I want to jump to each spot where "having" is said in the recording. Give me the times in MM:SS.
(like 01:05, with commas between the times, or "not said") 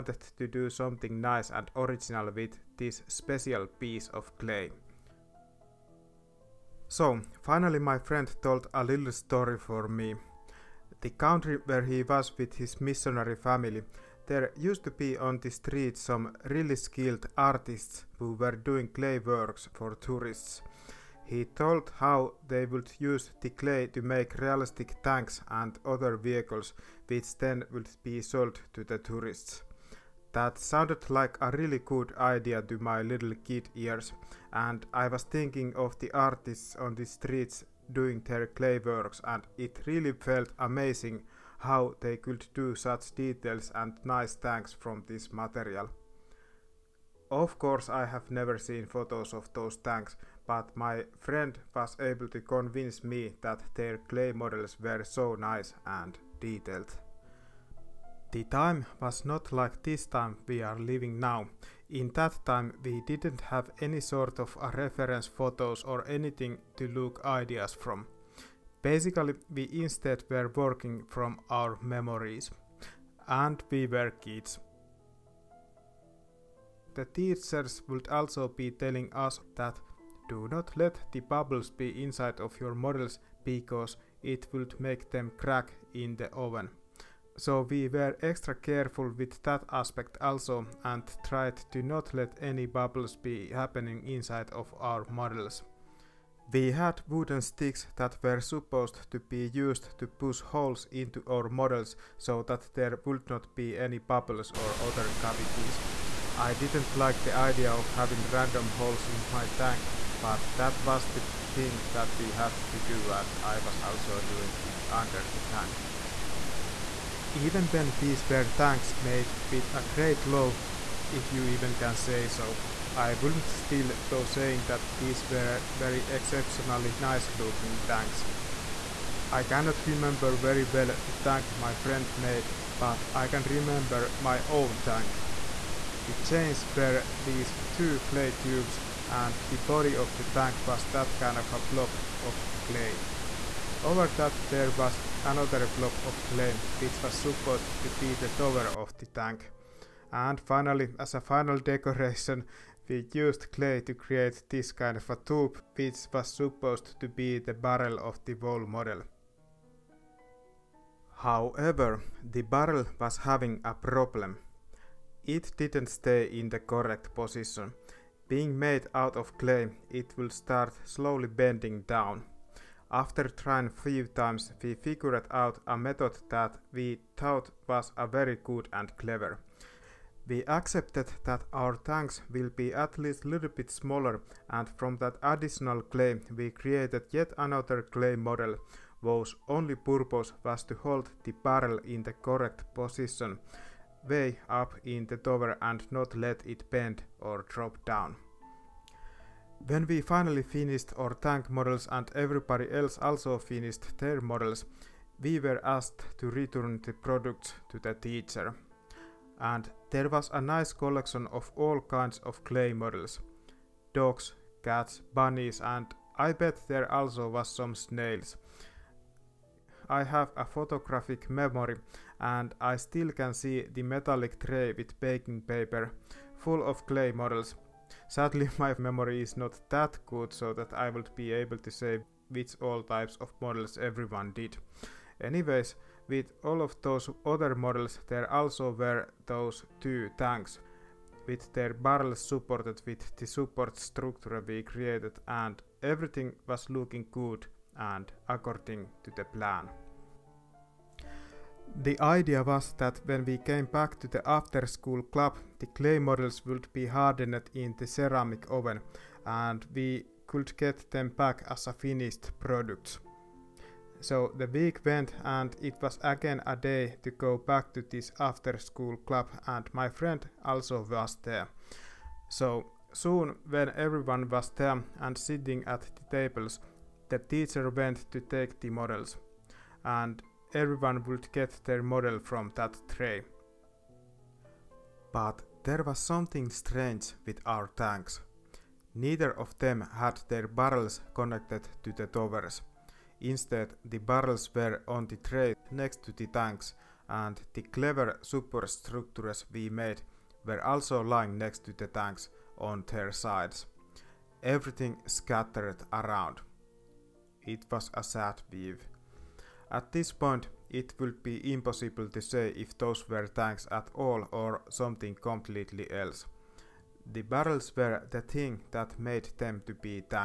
01:47, 02:43.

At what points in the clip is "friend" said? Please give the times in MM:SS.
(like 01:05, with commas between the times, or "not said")
00:07, 00:51, 02:11, 04:29.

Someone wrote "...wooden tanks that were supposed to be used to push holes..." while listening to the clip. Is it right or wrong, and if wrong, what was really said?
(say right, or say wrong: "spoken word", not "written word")
wrong: "sticks", not "tanks".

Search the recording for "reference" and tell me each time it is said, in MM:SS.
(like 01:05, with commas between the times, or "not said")
01:04.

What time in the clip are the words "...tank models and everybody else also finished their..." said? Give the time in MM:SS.
03:21.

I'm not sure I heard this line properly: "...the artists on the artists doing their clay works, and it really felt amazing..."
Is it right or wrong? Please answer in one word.
wrong.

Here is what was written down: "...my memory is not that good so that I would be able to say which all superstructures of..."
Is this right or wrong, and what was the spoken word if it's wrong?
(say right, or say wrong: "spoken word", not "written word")
wrong: "types", not "superstructures".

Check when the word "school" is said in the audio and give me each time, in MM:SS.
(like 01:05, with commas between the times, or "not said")
04:14, 04:28.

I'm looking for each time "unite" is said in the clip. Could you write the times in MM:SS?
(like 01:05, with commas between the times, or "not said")
not said.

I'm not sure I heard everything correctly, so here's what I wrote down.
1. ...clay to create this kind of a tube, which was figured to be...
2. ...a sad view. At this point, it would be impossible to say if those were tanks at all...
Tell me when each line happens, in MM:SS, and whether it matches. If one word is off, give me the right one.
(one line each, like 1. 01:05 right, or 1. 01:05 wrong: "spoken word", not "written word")
1. 02:33 wrong: "supposed", not "figured"
2. 05:07 right.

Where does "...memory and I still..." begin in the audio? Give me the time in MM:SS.
03:41.